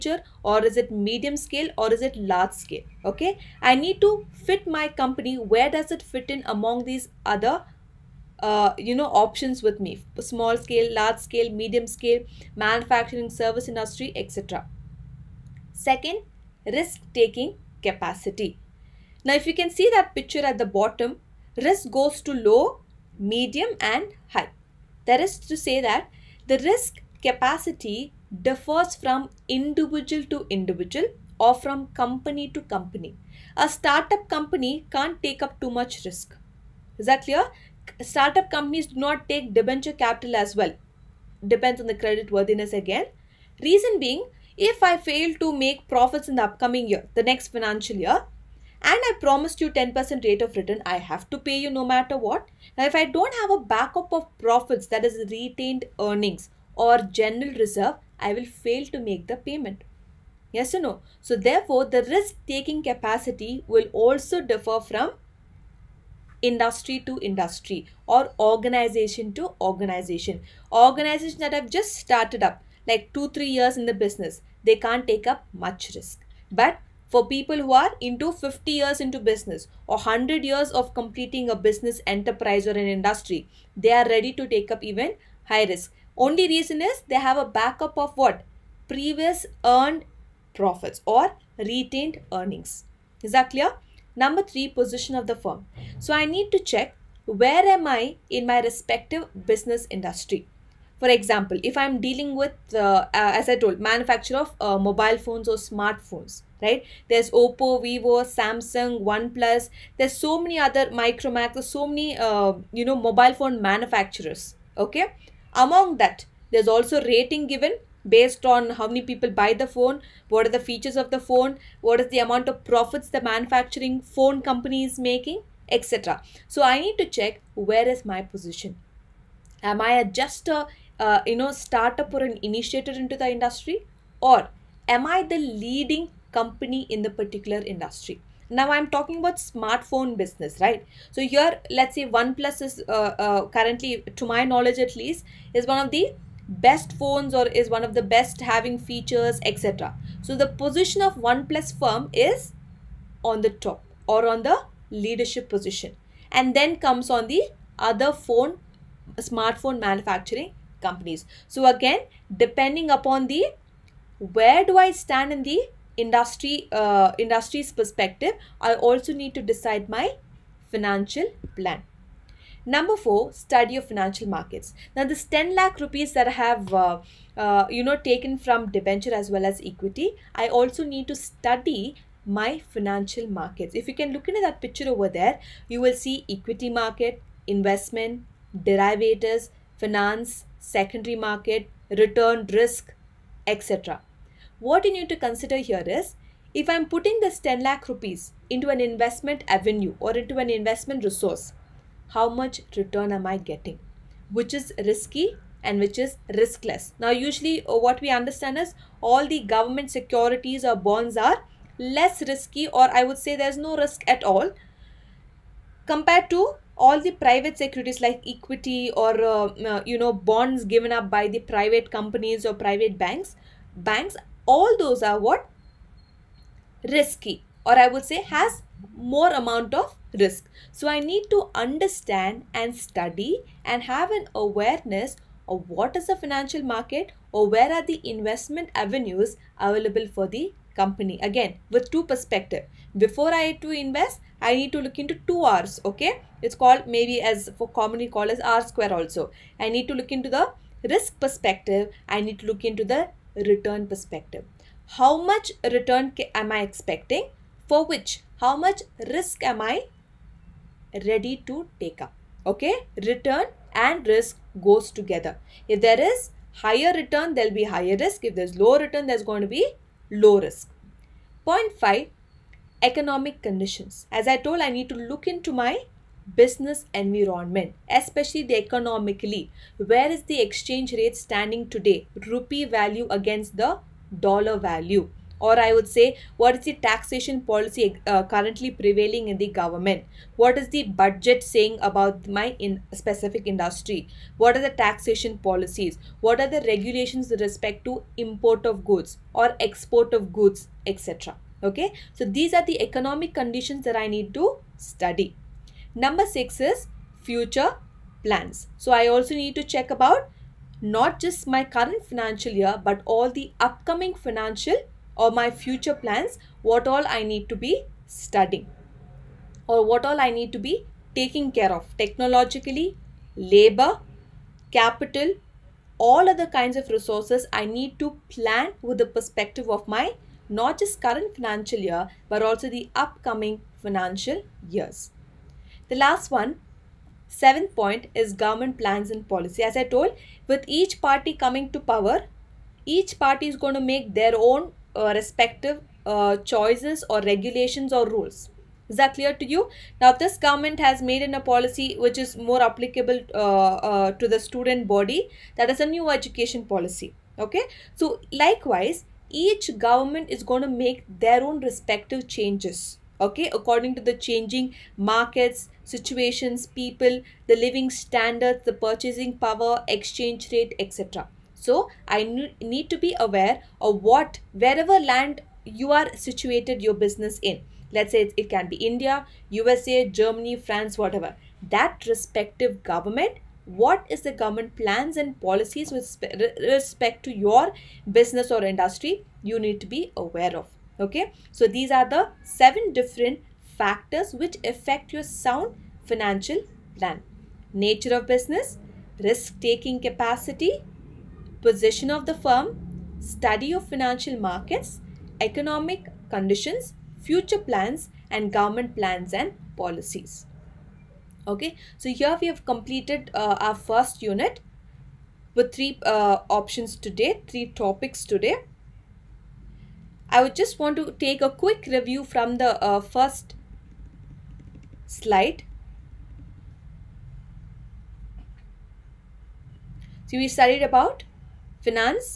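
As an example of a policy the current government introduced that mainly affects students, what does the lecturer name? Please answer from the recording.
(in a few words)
New education policy.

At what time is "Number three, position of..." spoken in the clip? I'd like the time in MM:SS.
01:34.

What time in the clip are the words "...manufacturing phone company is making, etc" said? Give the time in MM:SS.
02:03.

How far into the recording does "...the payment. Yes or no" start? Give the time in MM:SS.
00:59.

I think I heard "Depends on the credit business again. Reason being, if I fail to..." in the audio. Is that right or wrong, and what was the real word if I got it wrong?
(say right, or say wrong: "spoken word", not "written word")
wrong: "worthiness", not "business".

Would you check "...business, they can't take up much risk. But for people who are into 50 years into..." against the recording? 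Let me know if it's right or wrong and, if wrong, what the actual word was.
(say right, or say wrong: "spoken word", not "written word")
right.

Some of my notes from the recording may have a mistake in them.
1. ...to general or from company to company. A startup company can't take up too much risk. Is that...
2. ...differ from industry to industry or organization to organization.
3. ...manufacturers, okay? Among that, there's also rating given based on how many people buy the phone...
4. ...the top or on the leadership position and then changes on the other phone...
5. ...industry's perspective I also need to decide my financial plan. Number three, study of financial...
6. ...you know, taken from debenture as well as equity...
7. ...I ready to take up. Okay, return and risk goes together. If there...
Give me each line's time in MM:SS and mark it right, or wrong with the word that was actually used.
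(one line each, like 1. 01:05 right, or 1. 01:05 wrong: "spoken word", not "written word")
1. 00:30 wrong: "individual", not "general"
2. 01:04 right
3. 01:53 right
4. 02:33 wrong: "comes", not "changes"
5. 02:47 wrong: "four", not "three"
6. 02:57 right
7. 04:19 right.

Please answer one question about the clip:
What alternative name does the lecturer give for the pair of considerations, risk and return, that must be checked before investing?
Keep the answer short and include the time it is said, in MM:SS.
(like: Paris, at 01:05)
R square, at 04:08.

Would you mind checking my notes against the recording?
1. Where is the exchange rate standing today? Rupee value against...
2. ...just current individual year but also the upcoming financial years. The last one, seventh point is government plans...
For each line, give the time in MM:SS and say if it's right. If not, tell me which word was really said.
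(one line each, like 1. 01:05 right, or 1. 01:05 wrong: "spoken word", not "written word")
1. 04:39 right
2. 05:30 wrong: "financial", not "individual".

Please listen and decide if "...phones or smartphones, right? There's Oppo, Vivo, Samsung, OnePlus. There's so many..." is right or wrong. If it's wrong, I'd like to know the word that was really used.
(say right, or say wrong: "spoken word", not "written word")
right.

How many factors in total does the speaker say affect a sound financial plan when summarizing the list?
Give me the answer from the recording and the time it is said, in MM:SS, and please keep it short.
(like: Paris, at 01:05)
7, at 06:32.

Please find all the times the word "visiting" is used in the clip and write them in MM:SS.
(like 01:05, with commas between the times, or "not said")
not said.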